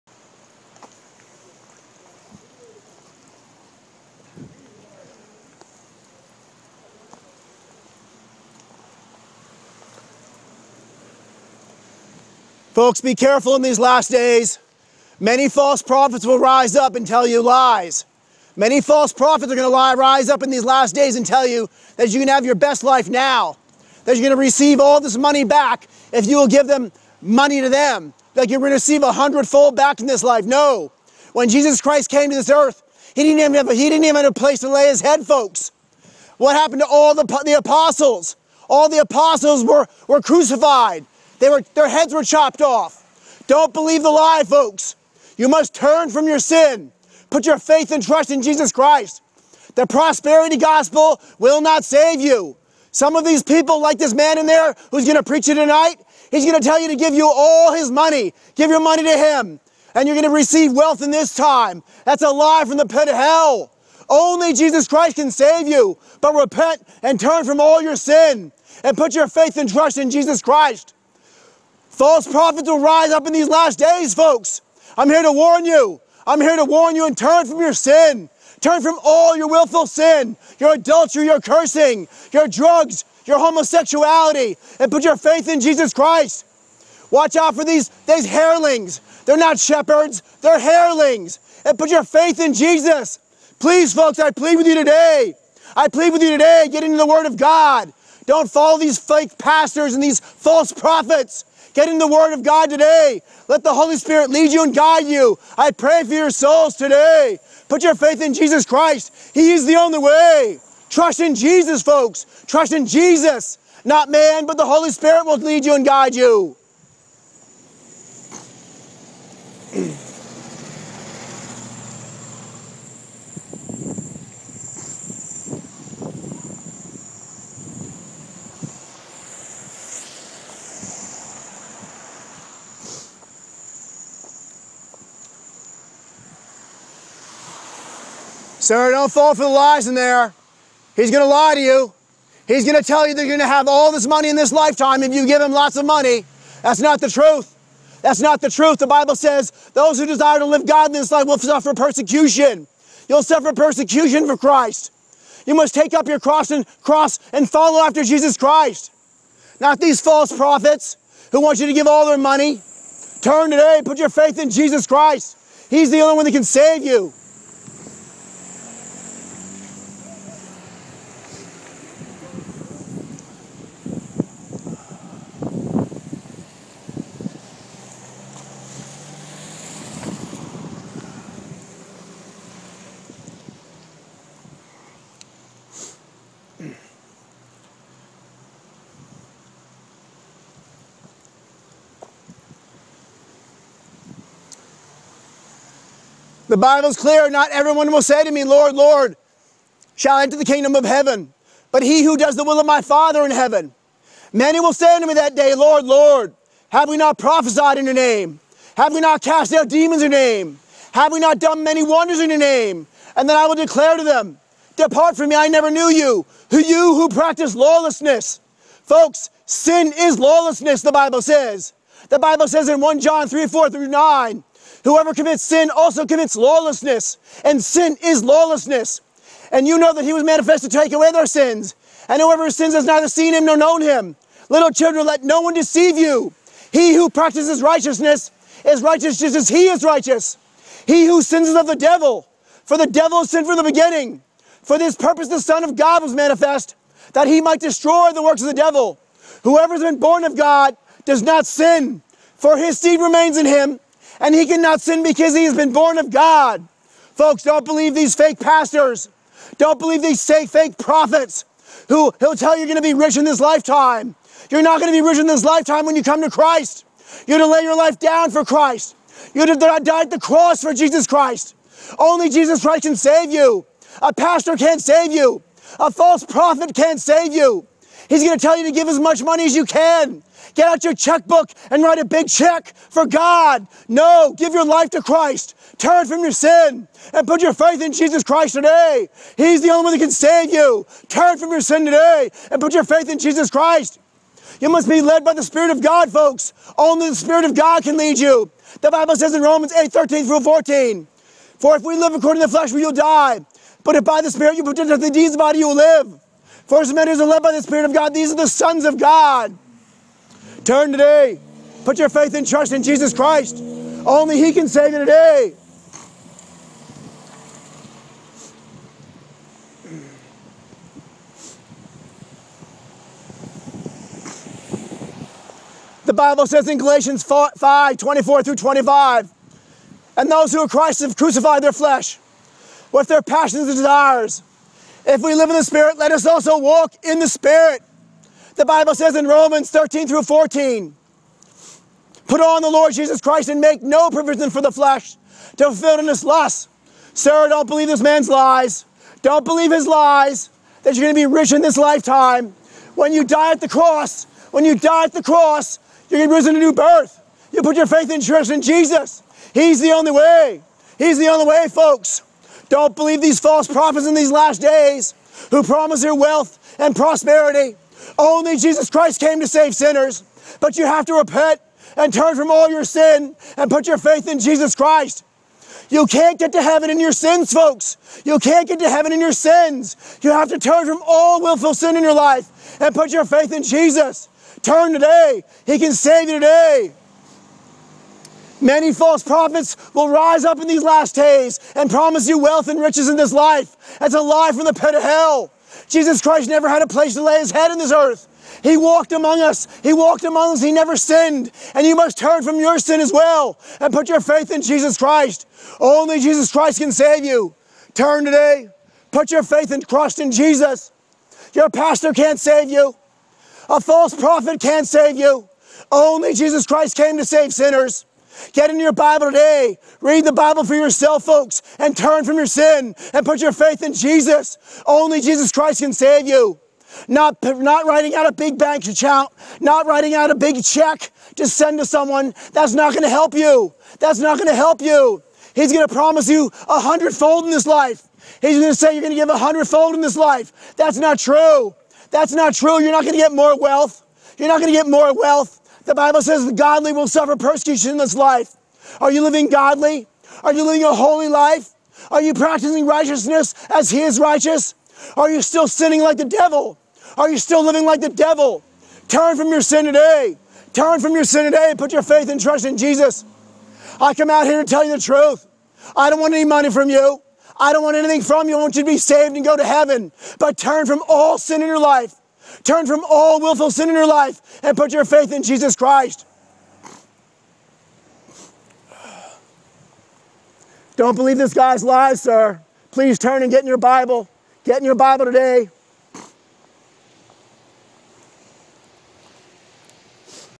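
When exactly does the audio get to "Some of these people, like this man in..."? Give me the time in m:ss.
0:52.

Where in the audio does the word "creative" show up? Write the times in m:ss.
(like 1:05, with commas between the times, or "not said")
not said.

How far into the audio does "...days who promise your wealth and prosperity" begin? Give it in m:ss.
6:04.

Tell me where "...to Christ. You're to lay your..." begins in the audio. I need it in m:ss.
4:26.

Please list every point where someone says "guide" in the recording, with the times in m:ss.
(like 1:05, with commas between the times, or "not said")
1:44, 1:55.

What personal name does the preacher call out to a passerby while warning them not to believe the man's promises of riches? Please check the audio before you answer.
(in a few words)
Sarah.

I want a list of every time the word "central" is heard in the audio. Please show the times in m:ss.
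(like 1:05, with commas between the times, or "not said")
not said.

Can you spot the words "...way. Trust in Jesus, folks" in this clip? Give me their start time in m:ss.
1:49.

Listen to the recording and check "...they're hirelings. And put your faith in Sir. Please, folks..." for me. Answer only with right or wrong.
wrong.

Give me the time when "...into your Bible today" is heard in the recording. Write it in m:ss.
6:58.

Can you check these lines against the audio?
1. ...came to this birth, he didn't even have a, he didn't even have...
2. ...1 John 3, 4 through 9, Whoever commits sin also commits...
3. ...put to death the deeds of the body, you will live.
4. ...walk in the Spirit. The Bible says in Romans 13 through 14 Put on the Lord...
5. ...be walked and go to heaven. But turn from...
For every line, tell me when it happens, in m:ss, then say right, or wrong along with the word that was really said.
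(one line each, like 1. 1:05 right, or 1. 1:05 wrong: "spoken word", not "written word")
1. 0:32 wrong: "earth", not "birth"
2. 3:42 right
3. 5:04 right
4. 5:36 right
5. 7:48 wrong: "saved", not "walked".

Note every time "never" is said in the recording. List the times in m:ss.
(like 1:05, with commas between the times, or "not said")
3:35, 6:36, 6:40.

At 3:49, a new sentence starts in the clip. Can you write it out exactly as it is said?
And you know that he was manifested to take away their sins.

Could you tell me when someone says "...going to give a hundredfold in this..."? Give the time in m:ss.
7:19.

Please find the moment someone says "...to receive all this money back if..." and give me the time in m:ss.
0:24.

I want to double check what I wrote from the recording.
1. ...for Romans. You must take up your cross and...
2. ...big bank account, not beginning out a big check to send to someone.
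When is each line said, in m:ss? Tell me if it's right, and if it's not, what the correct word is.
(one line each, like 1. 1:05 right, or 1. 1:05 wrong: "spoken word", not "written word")
1. 2:34 wrong: "Christ", not "Romans"
2. 7:08 wrong: "writing", not "beginning".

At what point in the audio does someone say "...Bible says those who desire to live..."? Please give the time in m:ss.
2:28.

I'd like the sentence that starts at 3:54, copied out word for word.
Little children, let no one deceive you.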